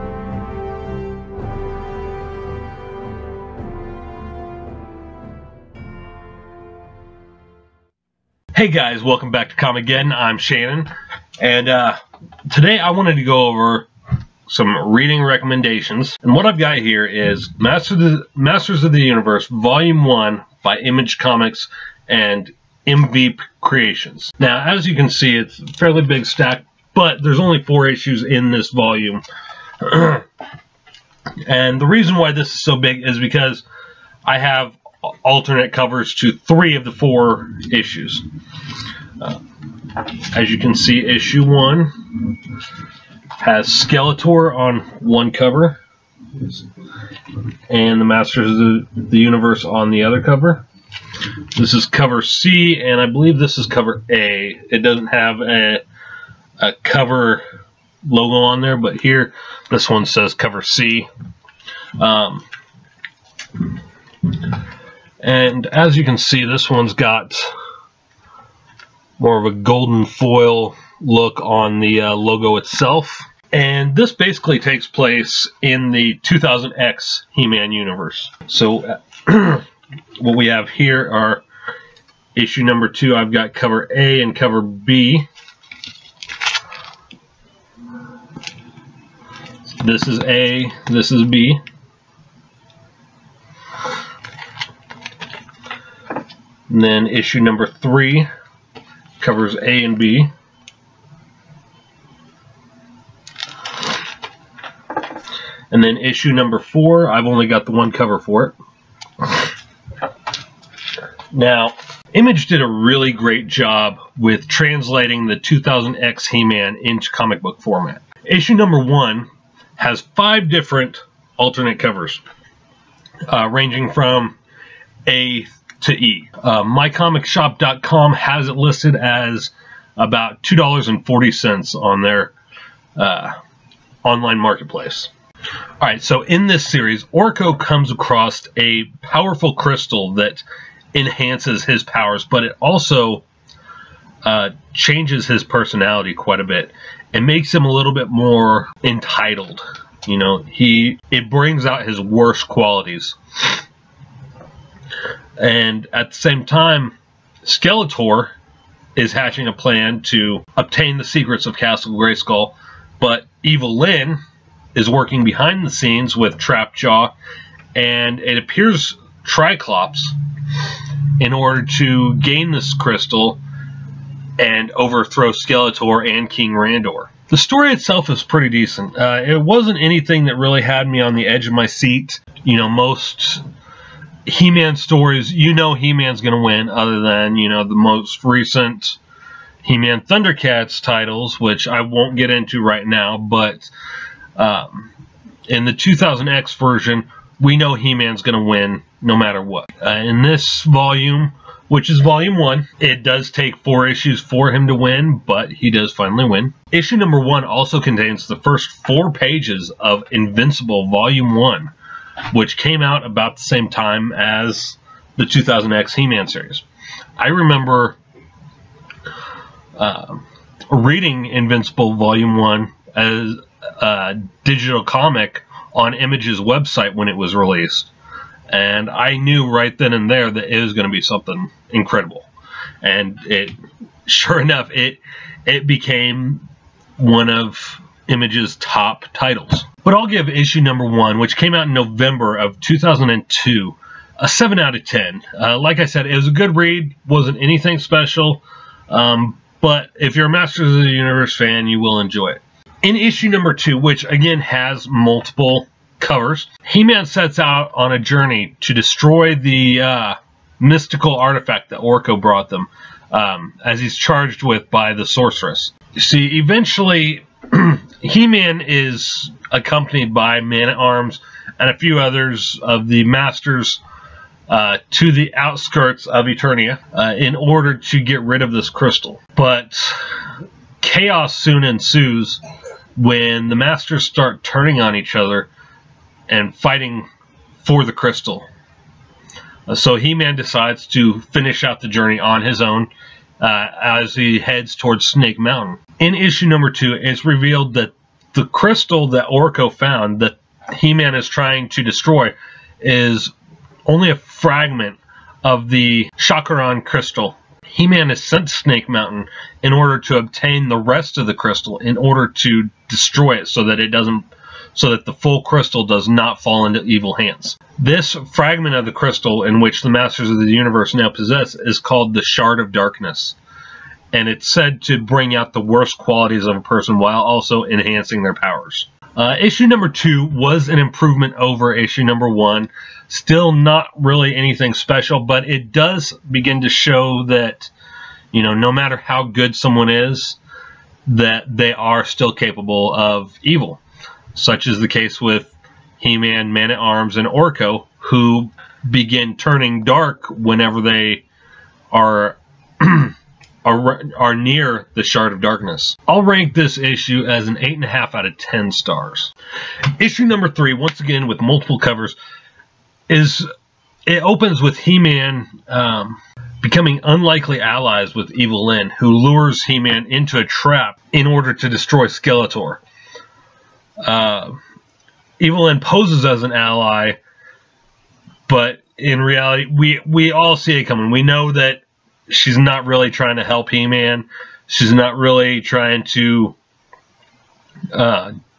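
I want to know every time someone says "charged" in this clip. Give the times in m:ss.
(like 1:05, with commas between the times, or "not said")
4:23.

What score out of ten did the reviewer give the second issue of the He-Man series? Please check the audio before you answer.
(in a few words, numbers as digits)
8.5.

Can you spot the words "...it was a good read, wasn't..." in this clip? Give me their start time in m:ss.
4:06.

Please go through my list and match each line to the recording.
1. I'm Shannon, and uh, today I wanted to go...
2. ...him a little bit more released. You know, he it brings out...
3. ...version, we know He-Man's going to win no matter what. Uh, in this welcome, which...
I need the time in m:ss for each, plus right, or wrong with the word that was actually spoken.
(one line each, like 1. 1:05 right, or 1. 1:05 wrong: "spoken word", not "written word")
1. 0:10 right
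2. 2:27 wrong: "entitled", not "released"
3. 3:16 wrong: "volume", not "welcome".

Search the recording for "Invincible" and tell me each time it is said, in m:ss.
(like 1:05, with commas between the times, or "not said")
3:30, 3:41.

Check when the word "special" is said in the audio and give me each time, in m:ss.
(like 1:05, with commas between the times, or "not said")
4:07, 5:34.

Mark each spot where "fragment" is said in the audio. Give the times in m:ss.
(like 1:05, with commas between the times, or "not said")
5:04, 5:18.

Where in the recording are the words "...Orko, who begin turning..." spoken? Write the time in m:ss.
5:47.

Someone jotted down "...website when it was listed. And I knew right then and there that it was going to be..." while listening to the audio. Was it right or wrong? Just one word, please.
wrong.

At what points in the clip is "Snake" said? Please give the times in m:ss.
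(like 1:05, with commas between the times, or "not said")
4:55, 5:08.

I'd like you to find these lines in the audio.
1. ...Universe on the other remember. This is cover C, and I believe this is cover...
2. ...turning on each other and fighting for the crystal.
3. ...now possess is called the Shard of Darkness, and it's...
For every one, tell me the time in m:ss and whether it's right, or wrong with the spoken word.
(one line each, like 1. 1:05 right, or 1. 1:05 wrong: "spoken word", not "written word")
1. 0:49 wrong: "cover", not "remember"
2. 4:44 right
3. 5:20 right.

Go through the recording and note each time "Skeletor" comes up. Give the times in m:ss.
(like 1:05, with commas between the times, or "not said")
0:43, 2:37, 2:55, 6:12.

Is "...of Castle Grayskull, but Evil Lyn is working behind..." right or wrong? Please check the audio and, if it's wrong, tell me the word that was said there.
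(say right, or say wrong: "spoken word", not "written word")
right.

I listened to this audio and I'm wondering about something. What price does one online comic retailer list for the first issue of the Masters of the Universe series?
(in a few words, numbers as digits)
$2.40.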